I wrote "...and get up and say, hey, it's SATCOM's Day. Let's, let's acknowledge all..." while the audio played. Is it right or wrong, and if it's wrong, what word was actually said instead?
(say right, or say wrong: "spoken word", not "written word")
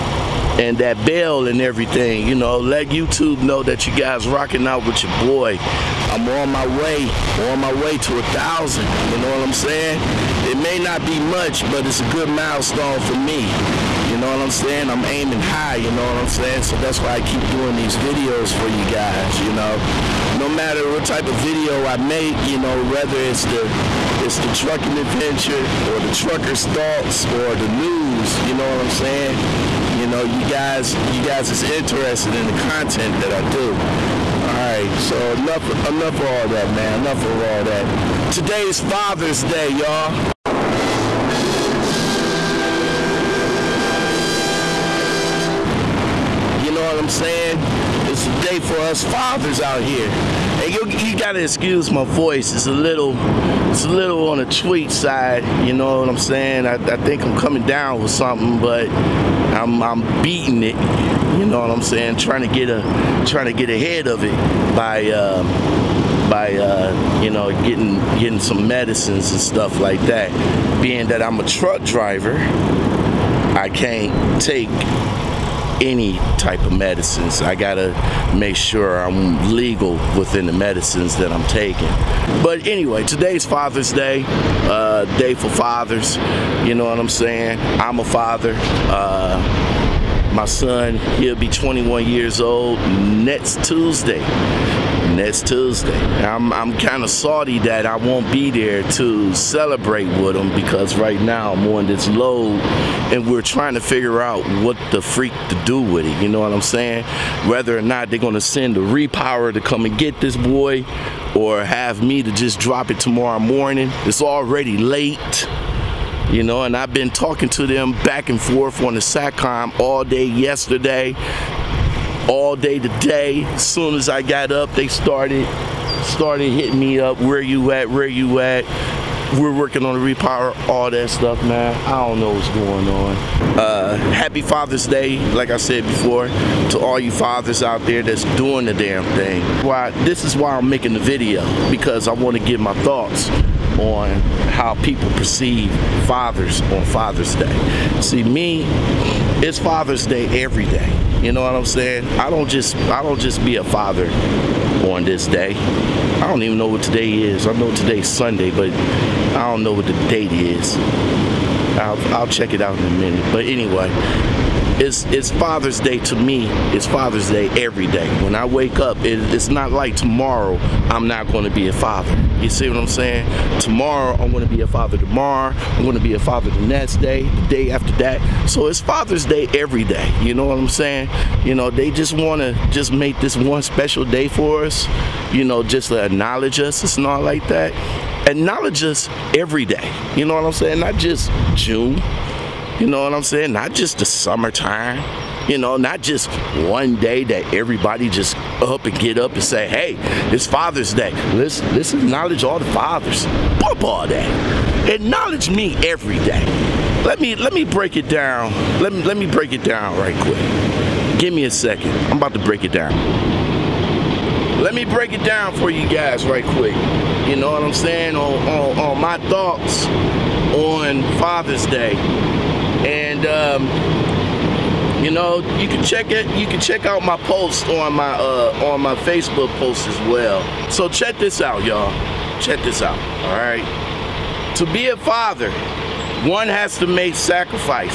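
wrong: "Father", not "SATCOM".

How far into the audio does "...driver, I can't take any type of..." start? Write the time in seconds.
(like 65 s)
71 s.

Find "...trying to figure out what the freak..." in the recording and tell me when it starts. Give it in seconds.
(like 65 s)
103 s.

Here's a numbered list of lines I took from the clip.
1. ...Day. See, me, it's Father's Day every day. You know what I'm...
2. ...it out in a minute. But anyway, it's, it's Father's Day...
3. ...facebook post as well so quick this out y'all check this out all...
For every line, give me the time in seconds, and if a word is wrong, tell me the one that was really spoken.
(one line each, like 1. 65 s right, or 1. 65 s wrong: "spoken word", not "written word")
1. 147 s right
2. 162 s right
3. 228 s wrong: "check", not "quick".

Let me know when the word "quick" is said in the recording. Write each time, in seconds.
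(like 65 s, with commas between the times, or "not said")
210 s, 216 s.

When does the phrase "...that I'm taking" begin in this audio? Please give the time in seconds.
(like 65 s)
81 s.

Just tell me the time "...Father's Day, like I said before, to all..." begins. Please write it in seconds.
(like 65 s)
134 s.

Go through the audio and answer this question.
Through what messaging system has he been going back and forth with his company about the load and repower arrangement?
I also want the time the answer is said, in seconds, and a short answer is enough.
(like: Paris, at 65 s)
SATCOM, at 119 s.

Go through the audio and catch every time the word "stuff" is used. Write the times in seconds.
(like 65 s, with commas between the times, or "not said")
69 s, 131 s.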